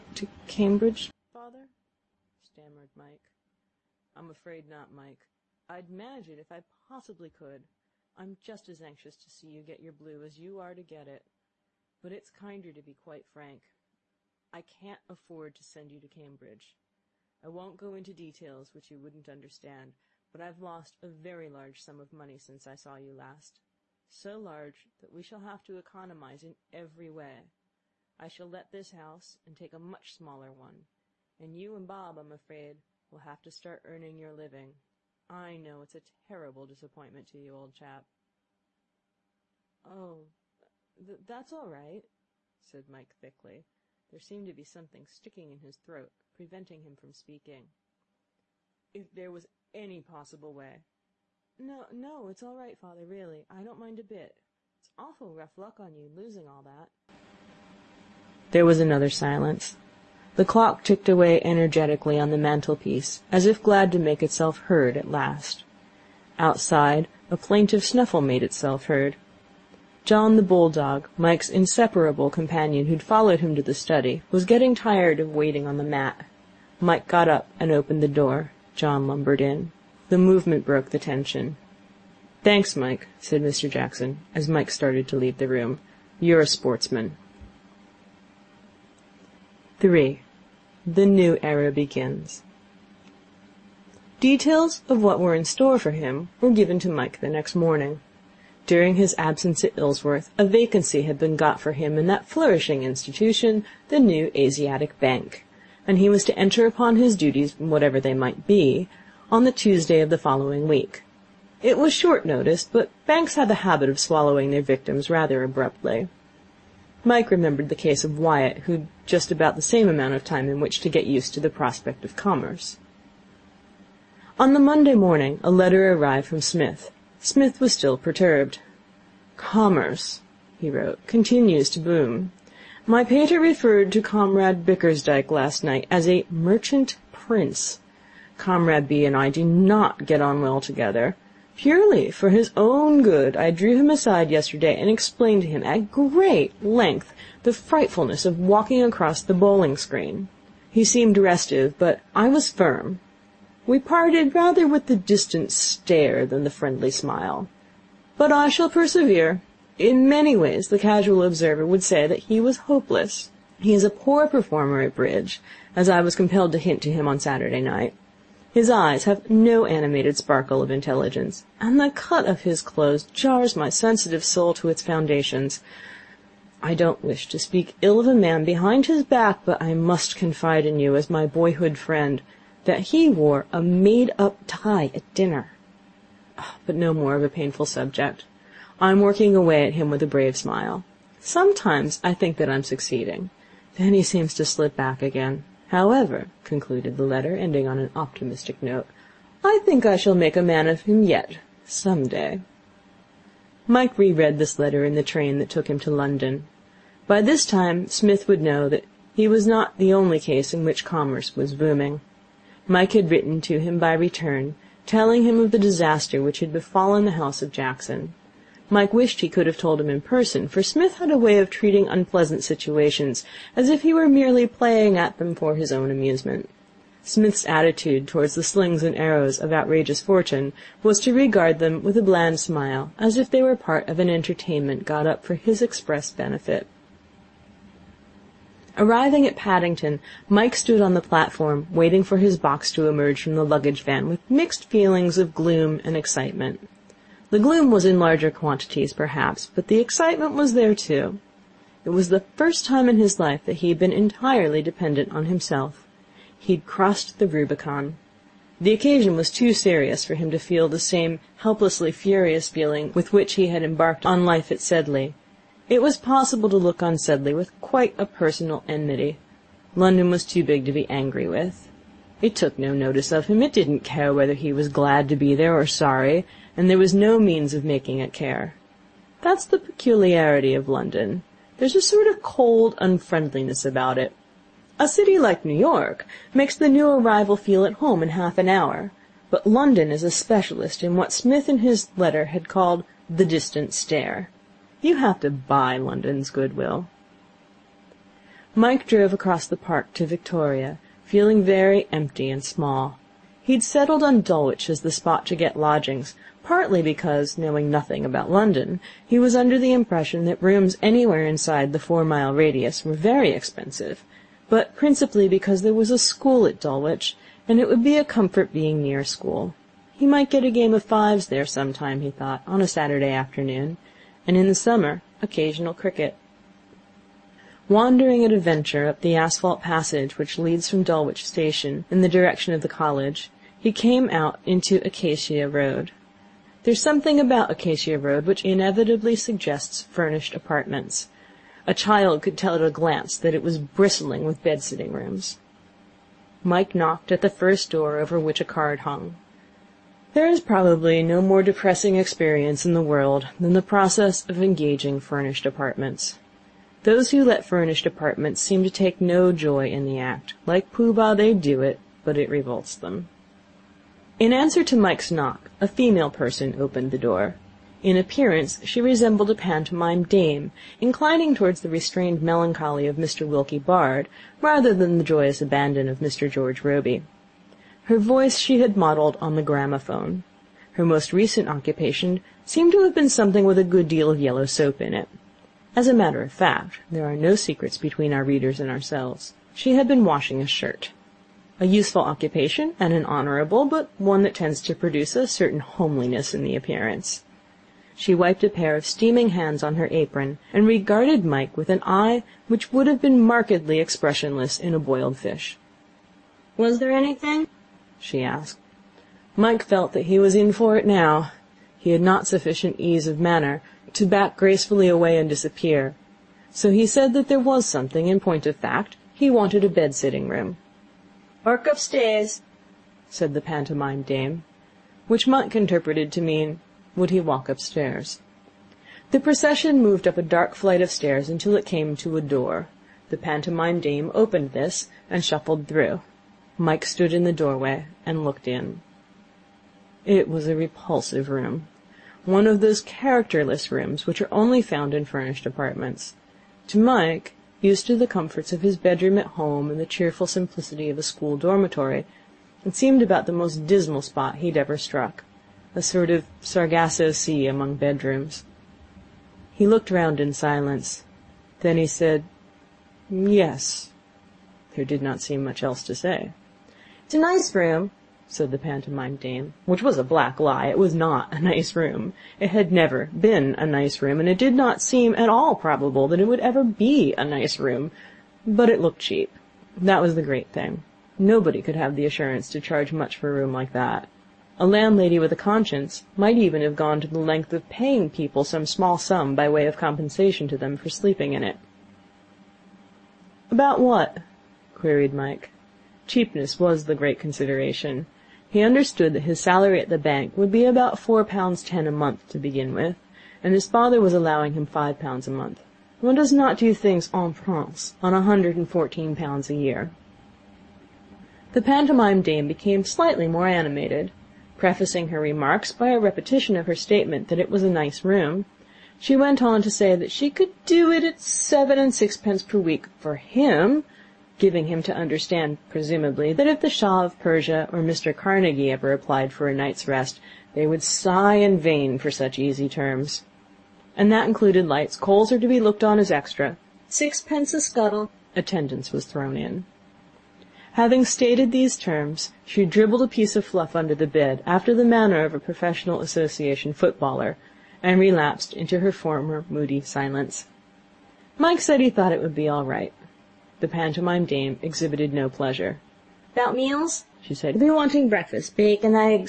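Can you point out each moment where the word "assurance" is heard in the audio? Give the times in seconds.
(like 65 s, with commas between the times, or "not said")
482 s.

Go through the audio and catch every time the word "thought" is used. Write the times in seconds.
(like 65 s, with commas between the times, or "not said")
322 s, 551 s.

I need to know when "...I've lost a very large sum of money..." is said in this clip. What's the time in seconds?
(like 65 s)
20 s.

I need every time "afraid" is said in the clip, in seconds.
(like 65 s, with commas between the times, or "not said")
4 s, 32 s.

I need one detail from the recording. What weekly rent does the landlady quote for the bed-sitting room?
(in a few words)
seven and sixpence.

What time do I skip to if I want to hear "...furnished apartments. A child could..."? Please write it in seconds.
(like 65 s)
339 s.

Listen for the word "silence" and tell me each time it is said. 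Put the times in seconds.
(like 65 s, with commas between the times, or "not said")
59 s, 460 s, 549 s.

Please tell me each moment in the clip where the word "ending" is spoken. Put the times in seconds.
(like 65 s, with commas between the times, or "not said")
197 s.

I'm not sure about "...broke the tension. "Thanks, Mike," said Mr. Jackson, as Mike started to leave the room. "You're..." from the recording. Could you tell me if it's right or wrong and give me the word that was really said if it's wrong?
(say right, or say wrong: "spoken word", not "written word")
right.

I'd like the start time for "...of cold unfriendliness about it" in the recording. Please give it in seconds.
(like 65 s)
282 s.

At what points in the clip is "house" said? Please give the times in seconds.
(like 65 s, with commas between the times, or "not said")
28 s, 217 s.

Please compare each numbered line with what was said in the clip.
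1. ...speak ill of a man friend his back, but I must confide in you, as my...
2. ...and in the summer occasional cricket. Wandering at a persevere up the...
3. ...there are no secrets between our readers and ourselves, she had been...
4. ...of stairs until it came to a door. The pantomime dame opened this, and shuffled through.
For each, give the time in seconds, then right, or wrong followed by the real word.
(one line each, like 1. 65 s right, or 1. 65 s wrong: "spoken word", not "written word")
1. 177 s wrong: "behind", not "friend"
2. 324 s wrong: "venture", not "persevere"
3. 386 s right
4. 430 s right.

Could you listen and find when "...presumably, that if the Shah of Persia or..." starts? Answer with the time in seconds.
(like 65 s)
525 s.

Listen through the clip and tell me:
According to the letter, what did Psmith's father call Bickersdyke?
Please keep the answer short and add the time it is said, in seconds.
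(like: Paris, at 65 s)
a merchant prince, at 136 s.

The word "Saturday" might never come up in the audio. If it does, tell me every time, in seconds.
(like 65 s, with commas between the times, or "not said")
167 s, 322 s.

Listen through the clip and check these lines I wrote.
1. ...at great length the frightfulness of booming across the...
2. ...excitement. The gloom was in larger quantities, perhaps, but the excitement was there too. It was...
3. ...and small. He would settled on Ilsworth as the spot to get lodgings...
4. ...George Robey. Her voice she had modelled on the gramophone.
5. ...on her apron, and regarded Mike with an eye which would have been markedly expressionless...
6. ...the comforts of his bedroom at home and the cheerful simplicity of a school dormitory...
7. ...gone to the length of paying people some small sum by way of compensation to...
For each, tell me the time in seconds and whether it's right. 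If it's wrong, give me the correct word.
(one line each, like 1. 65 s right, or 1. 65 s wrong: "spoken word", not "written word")
1. 145 s wrong: "walking", not "booming"
2. 245 s right
3. 302 s wrong: "Dulwich", not "Ilsworth"
4. 376 s right
5. 399 s right
6. 447 s right
7. 486 s right.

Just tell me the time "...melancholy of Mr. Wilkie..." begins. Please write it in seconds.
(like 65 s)
372 s.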